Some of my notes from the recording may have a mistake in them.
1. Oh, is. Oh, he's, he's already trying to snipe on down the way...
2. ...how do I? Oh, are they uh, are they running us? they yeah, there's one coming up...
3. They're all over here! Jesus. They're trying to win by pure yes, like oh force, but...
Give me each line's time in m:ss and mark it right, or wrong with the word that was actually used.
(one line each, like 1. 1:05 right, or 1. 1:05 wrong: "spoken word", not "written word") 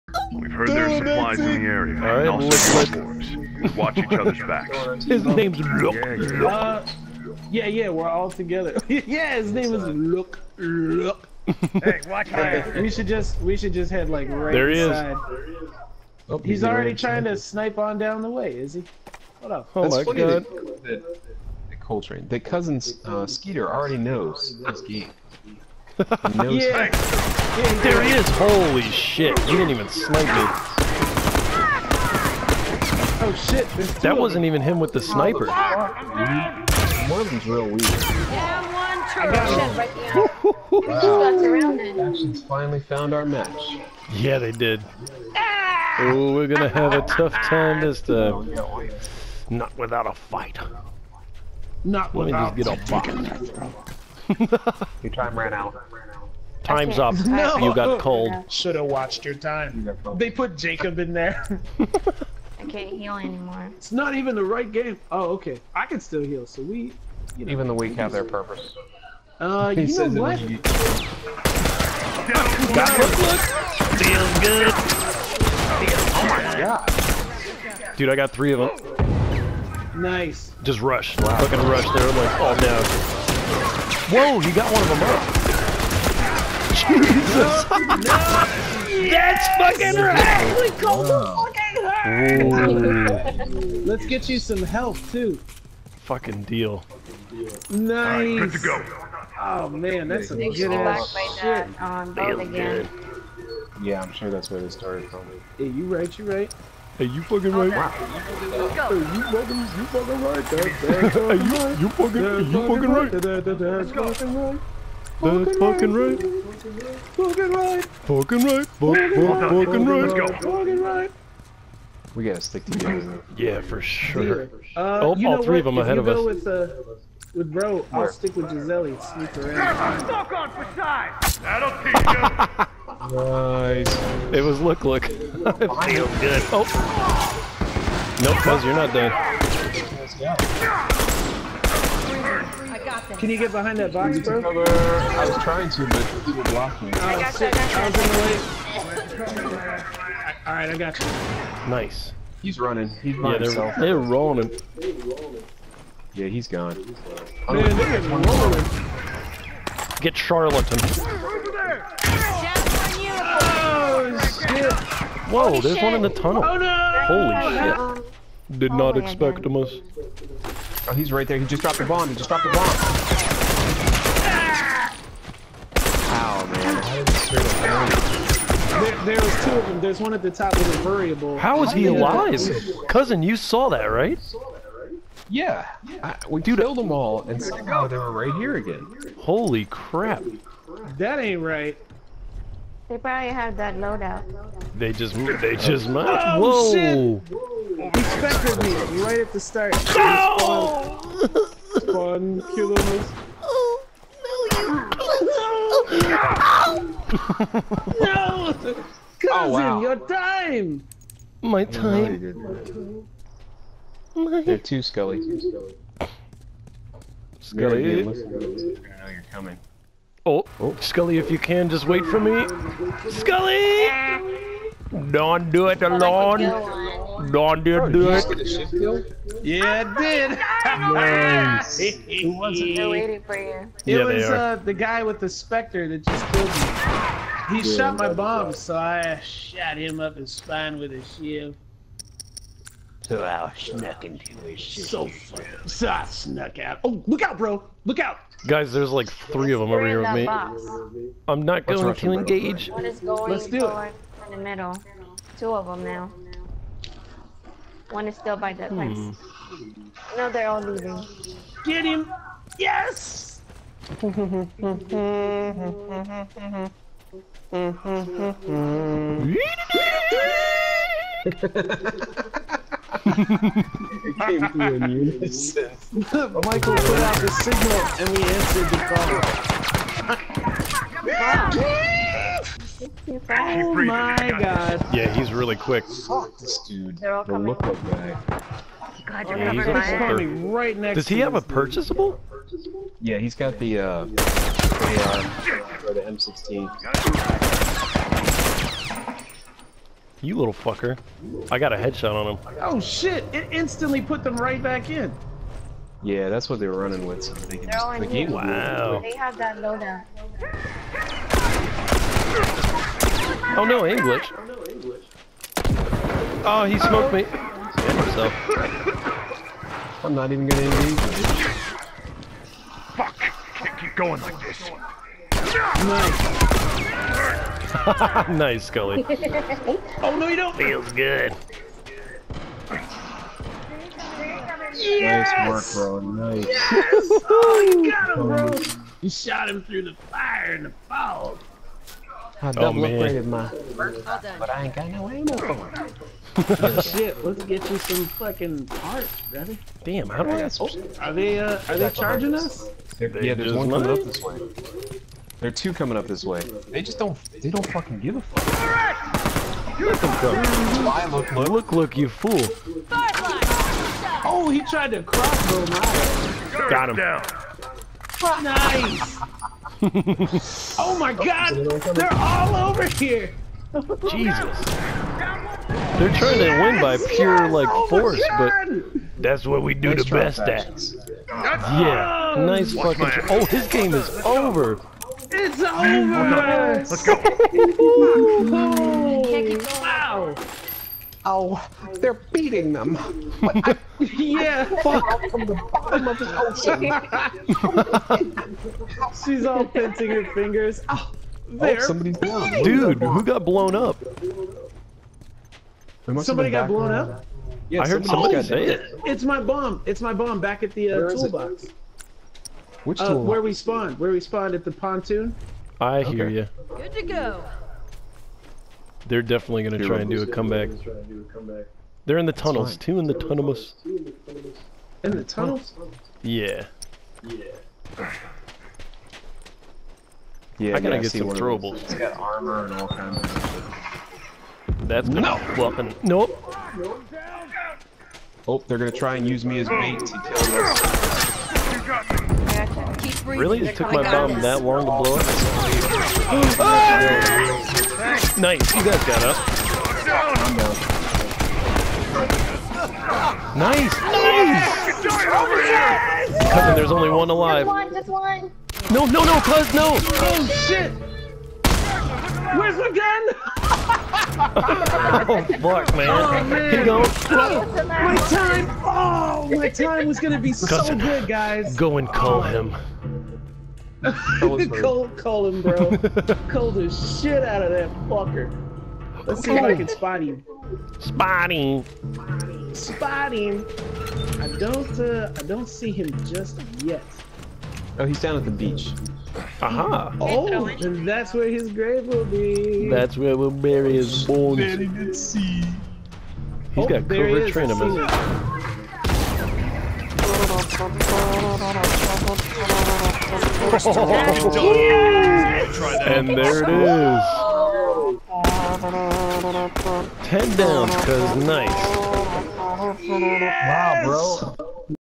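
1. 0:15 right
2. 5:50 wrong: "charging", not "running"
3. 6:11 right.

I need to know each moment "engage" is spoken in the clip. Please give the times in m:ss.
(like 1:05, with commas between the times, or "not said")
4:12, 5:20.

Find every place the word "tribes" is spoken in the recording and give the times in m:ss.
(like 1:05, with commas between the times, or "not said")
not said.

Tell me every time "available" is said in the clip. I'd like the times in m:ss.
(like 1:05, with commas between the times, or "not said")
not said.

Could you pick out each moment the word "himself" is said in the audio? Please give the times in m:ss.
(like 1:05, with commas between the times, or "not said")
2:33, 5:18.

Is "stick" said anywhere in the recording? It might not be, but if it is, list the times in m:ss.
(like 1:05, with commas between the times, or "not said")
2:02, 2:08.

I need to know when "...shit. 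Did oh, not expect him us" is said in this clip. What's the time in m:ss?
2:48.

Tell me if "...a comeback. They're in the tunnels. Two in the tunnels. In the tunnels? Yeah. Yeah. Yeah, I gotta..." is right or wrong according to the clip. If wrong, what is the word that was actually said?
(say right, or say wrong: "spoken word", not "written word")
right.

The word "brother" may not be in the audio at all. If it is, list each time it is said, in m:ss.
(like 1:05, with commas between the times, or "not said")
5:49.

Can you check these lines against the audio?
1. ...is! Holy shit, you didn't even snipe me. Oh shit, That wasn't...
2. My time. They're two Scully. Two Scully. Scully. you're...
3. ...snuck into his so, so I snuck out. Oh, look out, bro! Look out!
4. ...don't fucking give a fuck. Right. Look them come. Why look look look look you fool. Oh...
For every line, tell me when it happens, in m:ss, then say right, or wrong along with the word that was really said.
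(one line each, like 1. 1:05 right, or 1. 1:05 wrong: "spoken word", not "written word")
1. 0:28 right
2. 3:34 right
3. 4:03 right
4. 5:57 right.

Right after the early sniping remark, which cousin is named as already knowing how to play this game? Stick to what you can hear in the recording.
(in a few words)
Skeeter.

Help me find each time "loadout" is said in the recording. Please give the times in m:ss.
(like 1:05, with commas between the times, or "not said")
3:13, 5:09.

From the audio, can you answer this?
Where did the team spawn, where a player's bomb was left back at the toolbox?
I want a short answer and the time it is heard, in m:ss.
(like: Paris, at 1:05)
The pontoon, at 6:54.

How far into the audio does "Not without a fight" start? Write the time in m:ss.
0:49.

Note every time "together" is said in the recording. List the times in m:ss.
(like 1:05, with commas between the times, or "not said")
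0:08, 2:02.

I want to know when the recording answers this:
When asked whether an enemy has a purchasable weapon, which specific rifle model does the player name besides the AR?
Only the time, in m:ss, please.
4:56.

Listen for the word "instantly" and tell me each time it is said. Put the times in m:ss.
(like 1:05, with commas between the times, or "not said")
5:03.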